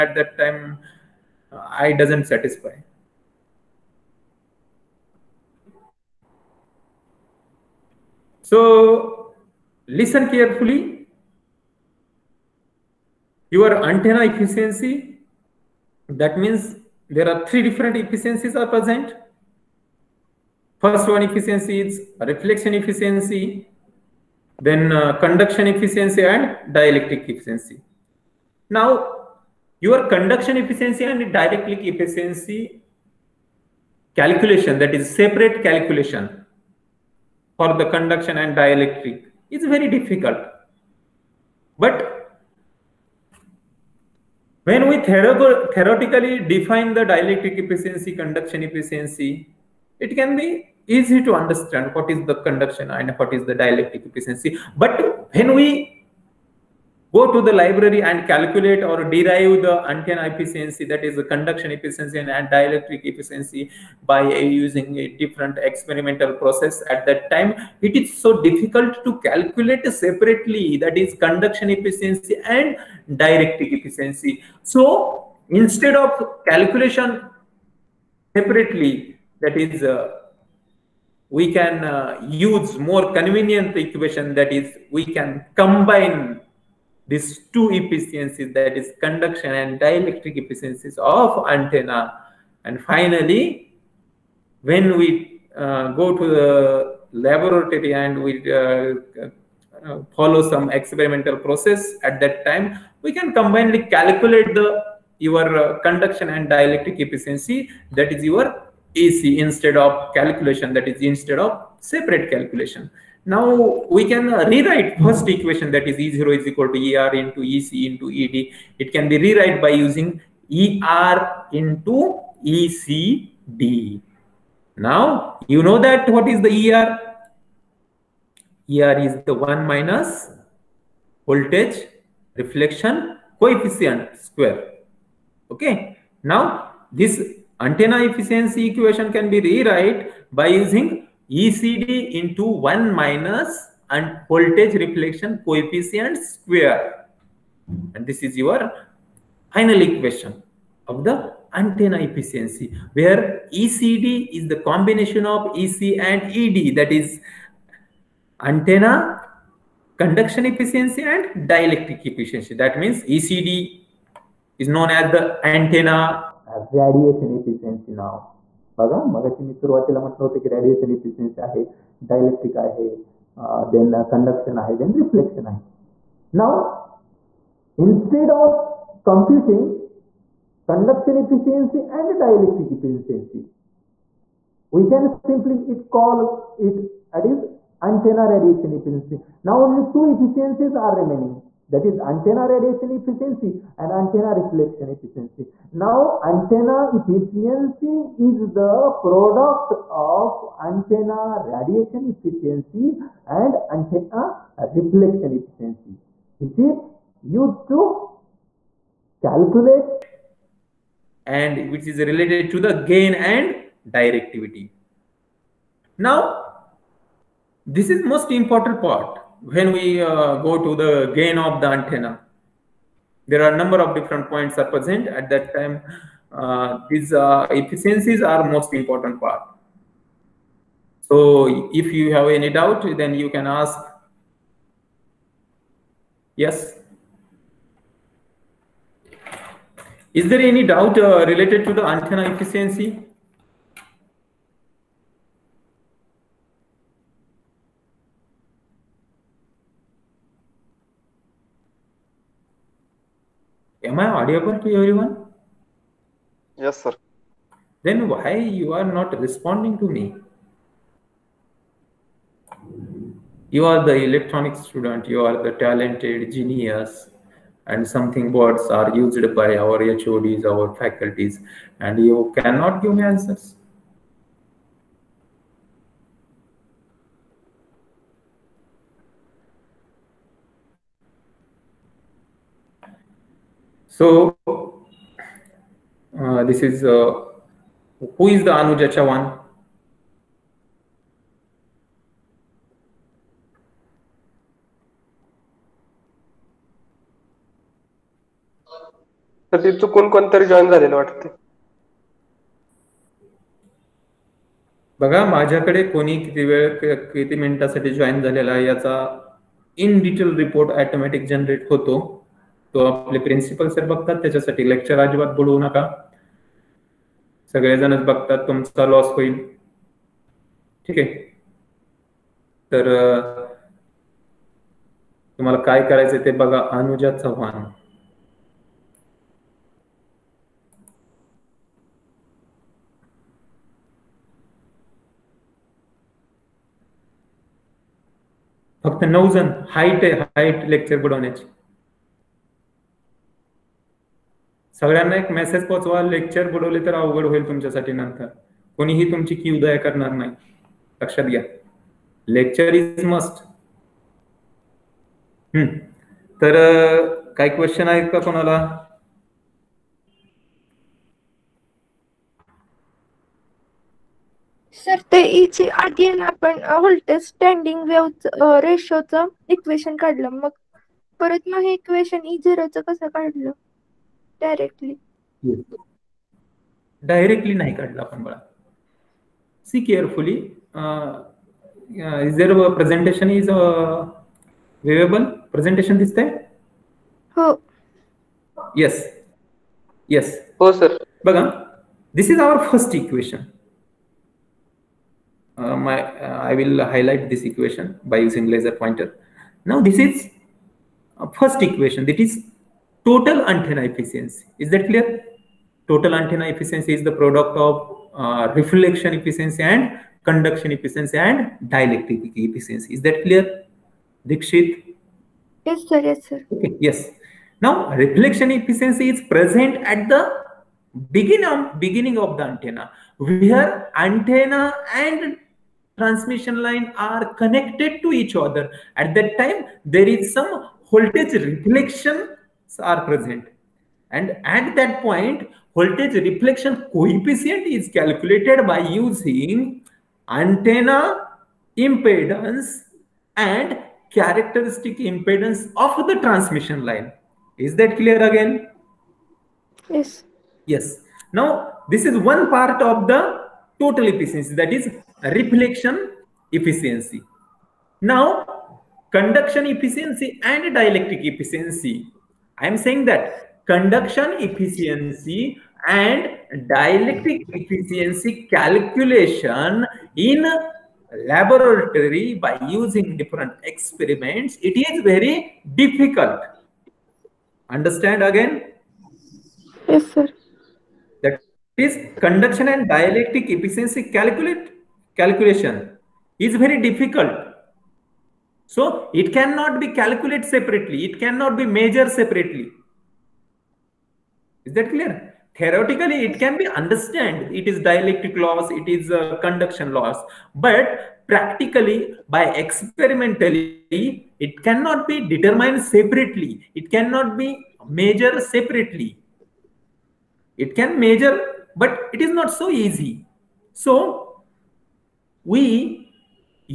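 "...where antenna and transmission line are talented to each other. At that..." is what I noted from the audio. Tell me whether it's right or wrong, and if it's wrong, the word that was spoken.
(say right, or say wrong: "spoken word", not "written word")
wrong: "connected", not "talented".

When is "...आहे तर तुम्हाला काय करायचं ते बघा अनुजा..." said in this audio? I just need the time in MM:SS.
05:20.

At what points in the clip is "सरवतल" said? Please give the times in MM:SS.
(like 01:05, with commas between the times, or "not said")
02:49.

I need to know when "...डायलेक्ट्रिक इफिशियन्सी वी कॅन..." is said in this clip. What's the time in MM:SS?
03:02.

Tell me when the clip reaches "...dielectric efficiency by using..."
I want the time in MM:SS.
01:02.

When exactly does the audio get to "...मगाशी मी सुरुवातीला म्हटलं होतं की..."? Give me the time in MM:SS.
02:49.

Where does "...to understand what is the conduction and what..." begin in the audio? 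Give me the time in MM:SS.
00:51.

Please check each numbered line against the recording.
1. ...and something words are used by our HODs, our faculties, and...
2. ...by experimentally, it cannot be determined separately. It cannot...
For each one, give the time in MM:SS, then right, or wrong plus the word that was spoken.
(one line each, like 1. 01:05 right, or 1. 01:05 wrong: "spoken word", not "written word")
1. 04:27 right
2. 08:22 right.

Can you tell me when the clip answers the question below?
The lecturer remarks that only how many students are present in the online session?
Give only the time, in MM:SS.
05:39.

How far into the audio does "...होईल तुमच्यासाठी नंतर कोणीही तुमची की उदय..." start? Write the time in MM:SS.
05:47.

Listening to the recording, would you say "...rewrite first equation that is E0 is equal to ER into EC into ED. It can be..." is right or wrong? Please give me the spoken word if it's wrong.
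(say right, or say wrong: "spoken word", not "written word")
right.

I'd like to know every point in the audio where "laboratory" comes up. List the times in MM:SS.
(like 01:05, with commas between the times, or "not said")
01:37, 07:51.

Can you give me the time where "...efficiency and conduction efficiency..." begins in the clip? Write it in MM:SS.
06:49.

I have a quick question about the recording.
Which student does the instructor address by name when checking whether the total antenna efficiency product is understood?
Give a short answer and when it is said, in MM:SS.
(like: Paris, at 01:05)
Dikshit, at 06:54.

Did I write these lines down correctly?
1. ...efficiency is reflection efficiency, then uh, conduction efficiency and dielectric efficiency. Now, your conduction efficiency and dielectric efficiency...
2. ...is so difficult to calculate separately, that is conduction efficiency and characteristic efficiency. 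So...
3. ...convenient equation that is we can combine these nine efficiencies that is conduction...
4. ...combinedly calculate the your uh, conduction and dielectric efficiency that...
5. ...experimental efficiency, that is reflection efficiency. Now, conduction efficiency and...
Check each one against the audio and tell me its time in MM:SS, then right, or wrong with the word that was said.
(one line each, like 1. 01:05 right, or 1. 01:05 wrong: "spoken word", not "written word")
1. 00:21 right
2. 01:08 wrong: "dielectric", not "characteristic"
3. 01:23 wrong: "two", not "nine"
4. 01:43 right
5. 07:33 wrong: "total", not "experimental".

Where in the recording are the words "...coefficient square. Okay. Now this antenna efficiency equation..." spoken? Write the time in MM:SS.
02:13.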